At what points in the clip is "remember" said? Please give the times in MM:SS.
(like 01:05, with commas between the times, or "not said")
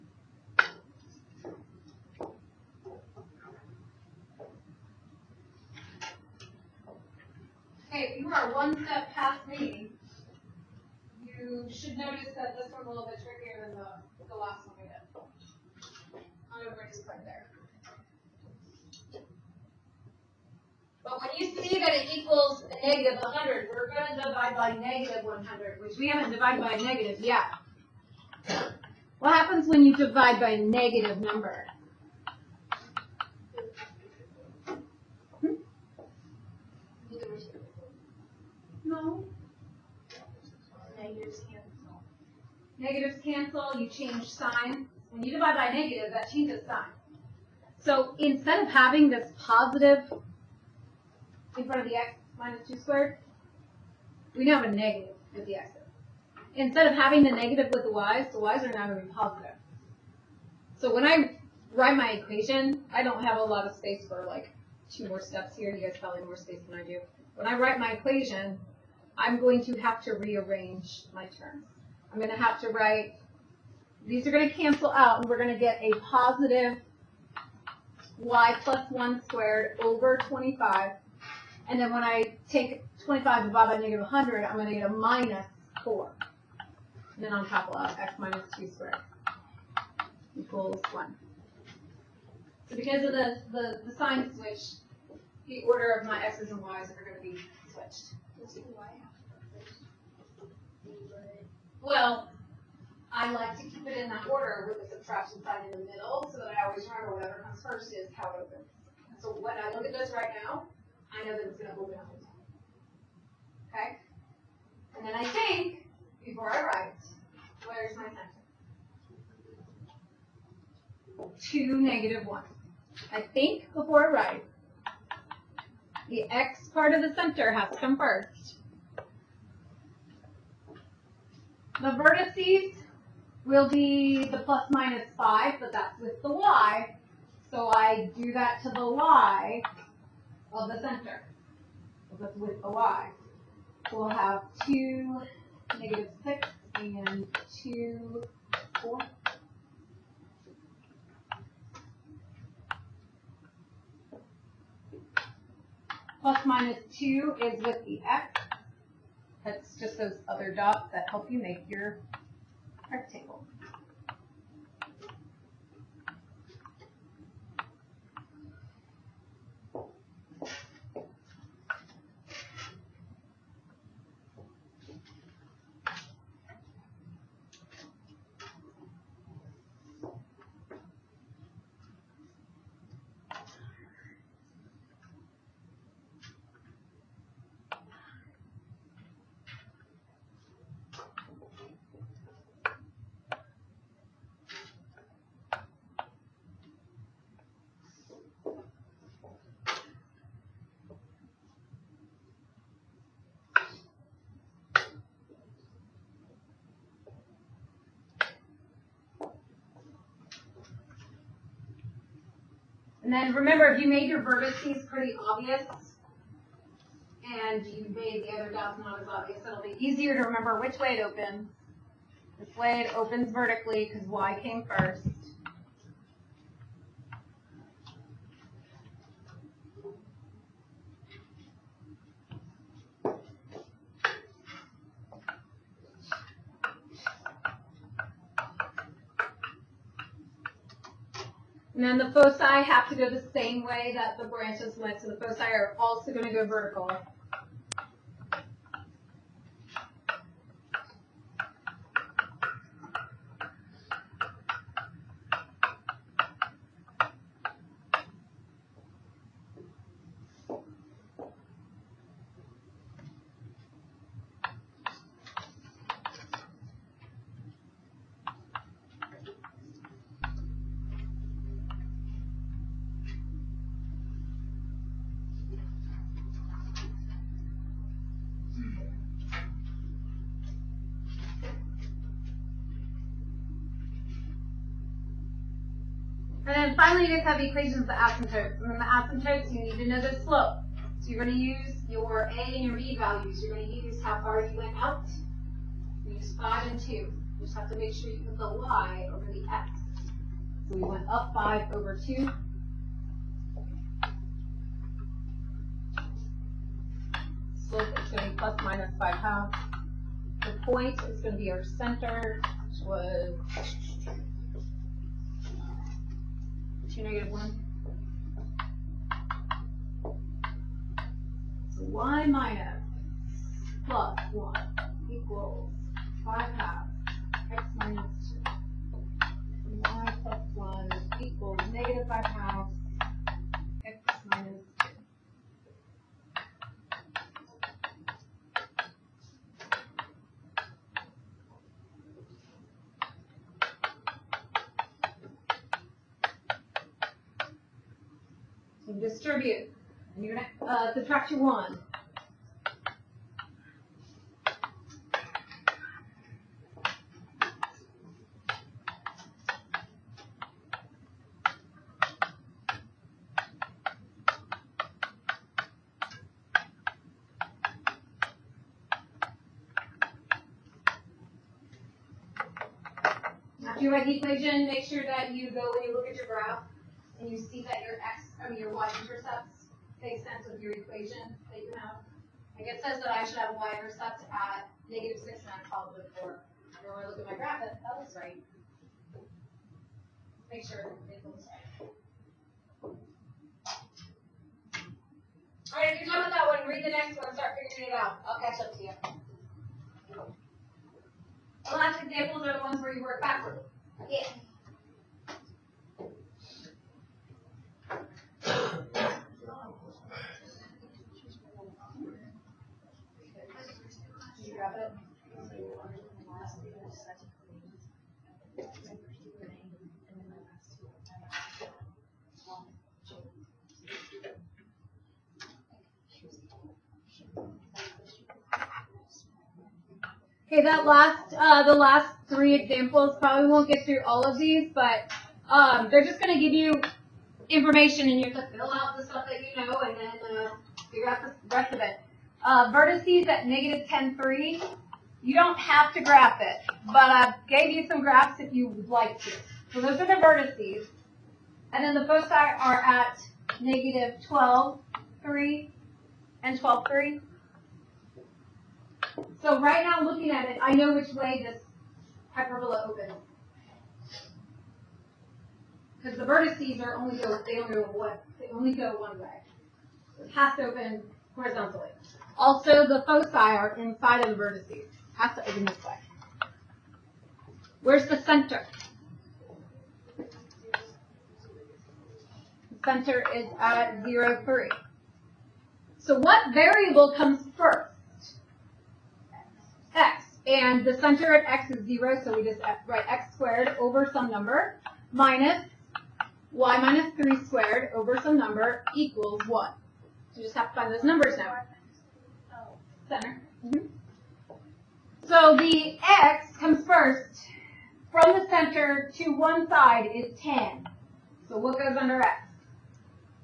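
01:46, 03:33, 03:40.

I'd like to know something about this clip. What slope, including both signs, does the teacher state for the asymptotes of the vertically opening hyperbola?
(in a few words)
±5/2.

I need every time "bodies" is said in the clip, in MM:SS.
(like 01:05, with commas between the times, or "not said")
not said.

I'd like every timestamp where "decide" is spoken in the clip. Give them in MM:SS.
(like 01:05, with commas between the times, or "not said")
not said.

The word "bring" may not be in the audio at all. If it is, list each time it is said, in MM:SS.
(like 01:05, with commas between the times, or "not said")
00:17.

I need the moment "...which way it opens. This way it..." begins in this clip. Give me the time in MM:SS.
03:40.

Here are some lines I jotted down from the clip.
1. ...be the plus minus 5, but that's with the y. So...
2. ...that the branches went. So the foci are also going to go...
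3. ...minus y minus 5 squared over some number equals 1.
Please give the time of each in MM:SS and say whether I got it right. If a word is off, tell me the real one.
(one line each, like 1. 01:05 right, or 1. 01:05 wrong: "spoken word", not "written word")
1. 02:13 right
2. 04:03 right
3. 08:15 wrong: "3", not "5".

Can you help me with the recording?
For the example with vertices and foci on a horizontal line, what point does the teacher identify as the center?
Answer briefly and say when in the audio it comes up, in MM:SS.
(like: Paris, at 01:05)
(0, 3), at 08:04.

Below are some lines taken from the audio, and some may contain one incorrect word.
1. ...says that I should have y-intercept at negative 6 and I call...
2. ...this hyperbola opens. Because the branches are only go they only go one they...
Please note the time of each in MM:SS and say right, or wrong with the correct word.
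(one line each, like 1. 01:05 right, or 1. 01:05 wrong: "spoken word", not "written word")
1. 06:22 right
2. 07:41 wrong: "vertices", not "branches".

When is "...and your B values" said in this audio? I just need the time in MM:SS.
04:52.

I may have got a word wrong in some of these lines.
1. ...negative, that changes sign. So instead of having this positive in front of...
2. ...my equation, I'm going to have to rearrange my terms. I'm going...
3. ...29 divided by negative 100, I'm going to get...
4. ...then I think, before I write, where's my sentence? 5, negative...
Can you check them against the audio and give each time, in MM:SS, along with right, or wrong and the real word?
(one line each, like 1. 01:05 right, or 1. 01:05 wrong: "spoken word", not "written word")
1. 00:45 right
2. 01:07 right
3. 01:23 wrong: "25", not "29"
4. 01:55 wrong: "2", not "5".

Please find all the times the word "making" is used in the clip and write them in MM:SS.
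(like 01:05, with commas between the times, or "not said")
not said.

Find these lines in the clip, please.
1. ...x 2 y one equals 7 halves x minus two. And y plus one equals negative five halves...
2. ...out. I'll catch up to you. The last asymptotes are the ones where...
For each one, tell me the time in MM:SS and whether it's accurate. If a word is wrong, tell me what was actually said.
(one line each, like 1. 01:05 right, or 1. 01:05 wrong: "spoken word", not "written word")
1. 05:27 wrong: "5", not "7"
2. 06:37 wrong: "examples", not "asymptotes".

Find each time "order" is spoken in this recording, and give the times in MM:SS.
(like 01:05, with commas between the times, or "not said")
01:35, 01:44.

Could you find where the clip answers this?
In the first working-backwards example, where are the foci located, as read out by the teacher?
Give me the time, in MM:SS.
07:33.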